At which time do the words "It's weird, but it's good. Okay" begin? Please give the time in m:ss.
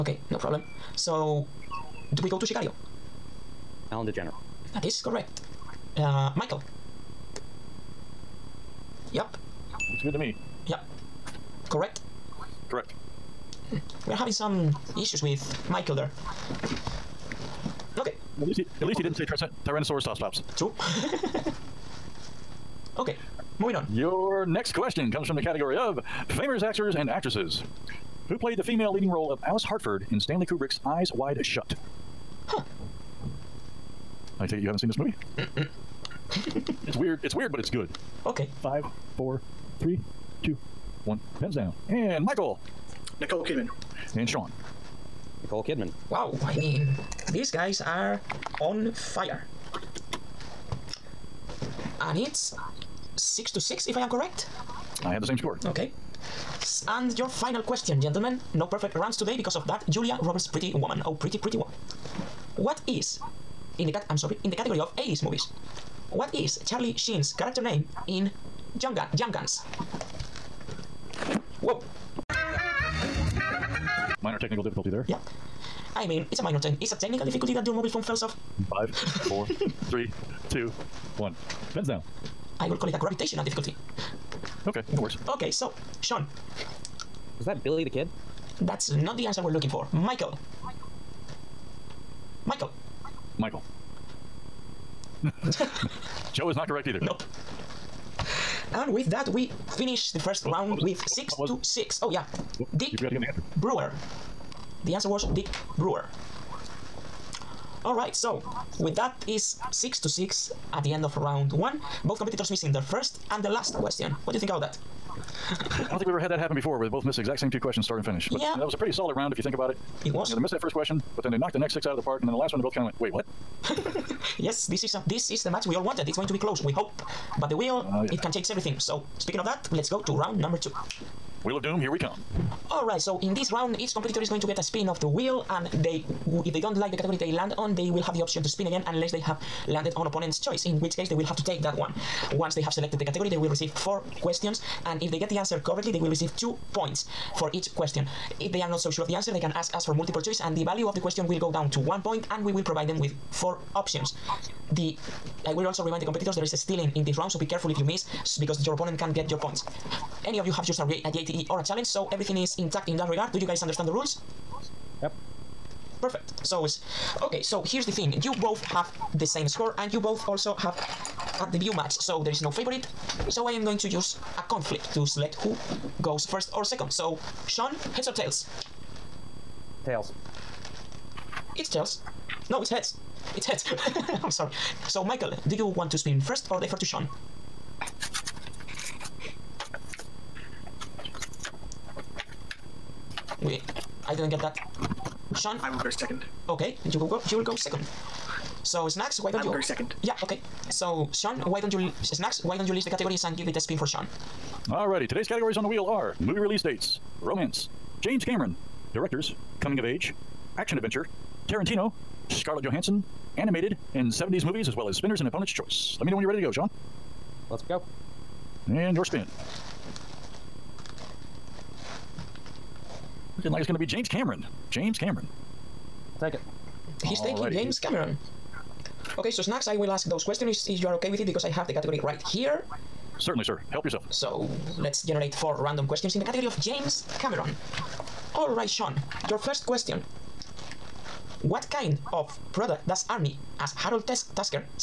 0:37.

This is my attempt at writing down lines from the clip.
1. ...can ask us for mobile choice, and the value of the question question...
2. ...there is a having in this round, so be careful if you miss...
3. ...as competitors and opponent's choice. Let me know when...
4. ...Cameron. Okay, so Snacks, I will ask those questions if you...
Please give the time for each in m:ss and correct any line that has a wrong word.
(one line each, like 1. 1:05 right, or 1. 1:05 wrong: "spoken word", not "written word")
1. 2:29 wrong: "multiple", not "mobile"
2. 2:36 wrong: "stealing", not "having"
3. 3:34 wrong: "spinners", not "competitors"
4. 3:47 right.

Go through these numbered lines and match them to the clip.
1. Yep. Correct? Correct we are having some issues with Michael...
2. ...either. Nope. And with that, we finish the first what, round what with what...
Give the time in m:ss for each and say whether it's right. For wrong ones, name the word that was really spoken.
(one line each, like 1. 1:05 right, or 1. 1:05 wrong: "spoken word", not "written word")
1. 0:10 right
2. 1:36 right.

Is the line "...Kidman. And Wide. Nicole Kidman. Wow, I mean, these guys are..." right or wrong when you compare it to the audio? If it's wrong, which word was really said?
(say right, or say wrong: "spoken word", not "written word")
wrong: "Sean", not "Wide".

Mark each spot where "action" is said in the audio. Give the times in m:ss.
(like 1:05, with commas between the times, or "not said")
3:30.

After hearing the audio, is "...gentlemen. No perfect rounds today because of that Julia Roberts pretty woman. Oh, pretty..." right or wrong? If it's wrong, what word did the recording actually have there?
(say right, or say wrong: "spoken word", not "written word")
right.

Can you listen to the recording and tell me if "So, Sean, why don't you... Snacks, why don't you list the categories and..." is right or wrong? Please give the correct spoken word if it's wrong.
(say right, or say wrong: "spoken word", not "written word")
right.